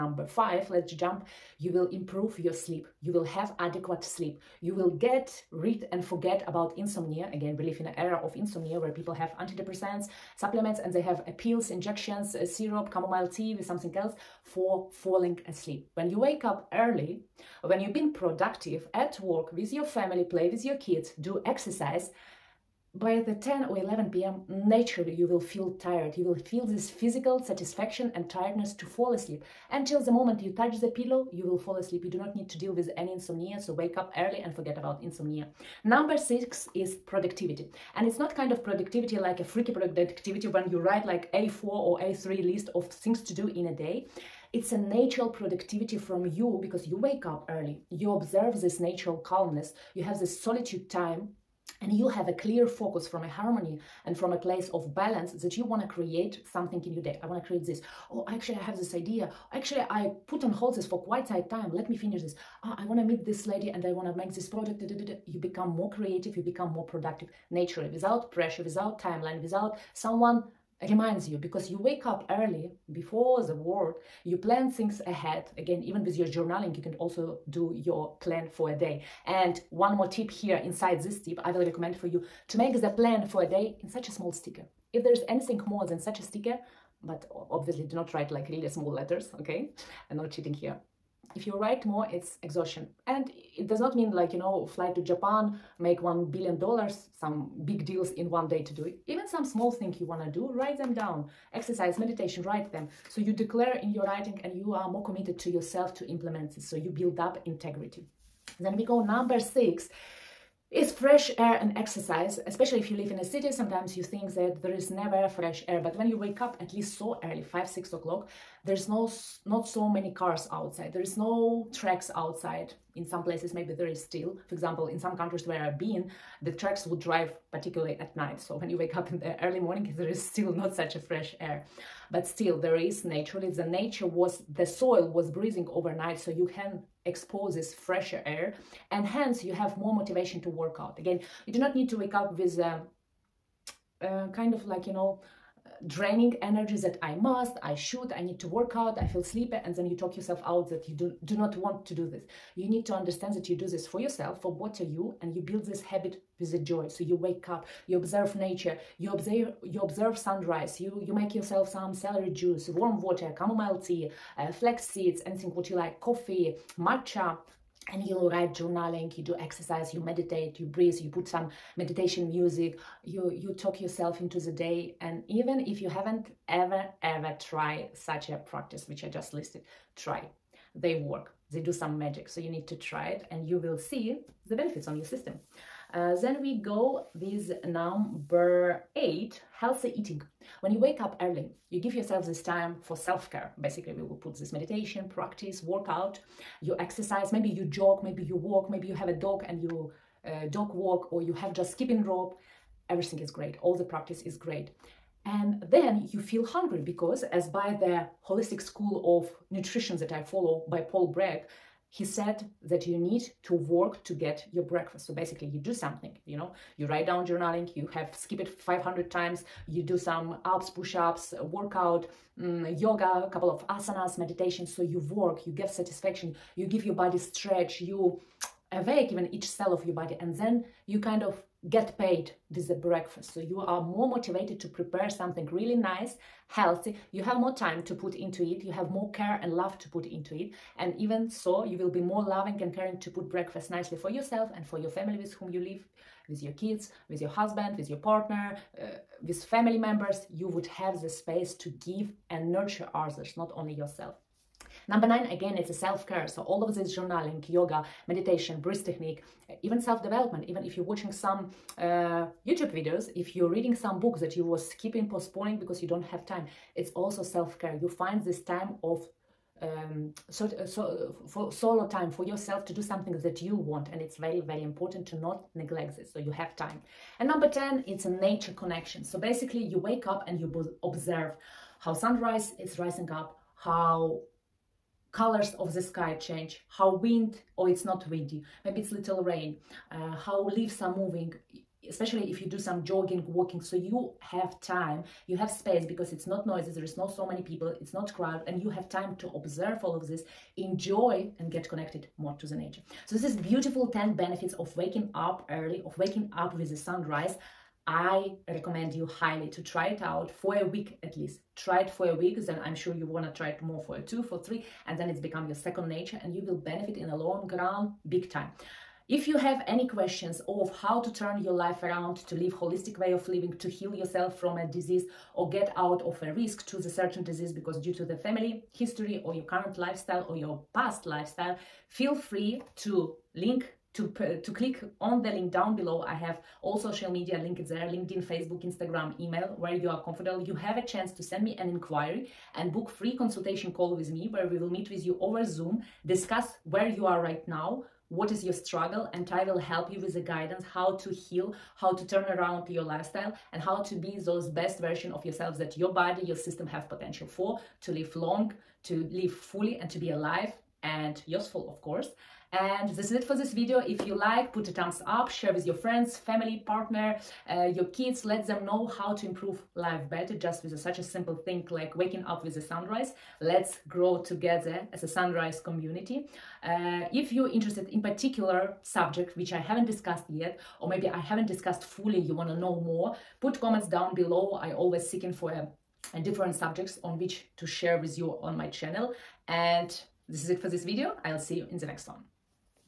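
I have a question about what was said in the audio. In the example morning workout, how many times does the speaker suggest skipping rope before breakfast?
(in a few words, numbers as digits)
500.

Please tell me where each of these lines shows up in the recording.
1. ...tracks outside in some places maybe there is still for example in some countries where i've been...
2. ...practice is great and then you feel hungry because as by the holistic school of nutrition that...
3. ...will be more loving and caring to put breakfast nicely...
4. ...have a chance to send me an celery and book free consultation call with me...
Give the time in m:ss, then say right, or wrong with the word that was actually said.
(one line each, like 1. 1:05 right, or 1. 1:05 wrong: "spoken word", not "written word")
1. 2:01 right
2. 3:23 right
3. 4:01 right
4. 5:40 wrong: "inquiry", not "celery".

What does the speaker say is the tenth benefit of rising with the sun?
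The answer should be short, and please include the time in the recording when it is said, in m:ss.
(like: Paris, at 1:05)
Nature connection, at 4:38.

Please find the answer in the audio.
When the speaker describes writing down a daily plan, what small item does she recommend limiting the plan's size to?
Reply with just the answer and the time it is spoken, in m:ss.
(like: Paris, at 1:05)
a sticker, at 1:23.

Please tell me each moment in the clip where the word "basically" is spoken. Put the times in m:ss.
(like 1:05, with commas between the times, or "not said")
3:13, 3:35, 4:39.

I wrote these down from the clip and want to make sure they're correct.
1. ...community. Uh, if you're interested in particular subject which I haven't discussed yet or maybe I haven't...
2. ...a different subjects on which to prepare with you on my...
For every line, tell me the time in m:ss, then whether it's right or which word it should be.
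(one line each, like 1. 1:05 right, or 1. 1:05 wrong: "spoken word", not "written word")
1. 6:15 right
2. 6:26 wrong: "share", not "prepare".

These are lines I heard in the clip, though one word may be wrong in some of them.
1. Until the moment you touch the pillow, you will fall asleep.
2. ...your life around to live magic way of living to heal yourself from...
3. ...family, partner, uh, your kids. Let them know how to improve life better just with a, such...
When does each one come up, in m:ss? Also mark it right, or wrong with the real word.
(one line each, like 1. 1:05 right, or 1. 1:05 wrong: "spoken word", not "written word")
1. 0:29 right
2. 5:21 wrong: "holistic", not "magic"
3. 6:06 right.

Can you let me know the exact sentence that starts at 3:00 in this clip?
They work, they do some magic.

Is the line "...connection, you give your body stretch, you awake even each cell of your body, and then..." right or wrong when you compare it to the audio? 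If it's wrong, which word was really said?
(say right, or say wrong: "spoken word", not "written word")
wrong: "satisfaction", not "connection".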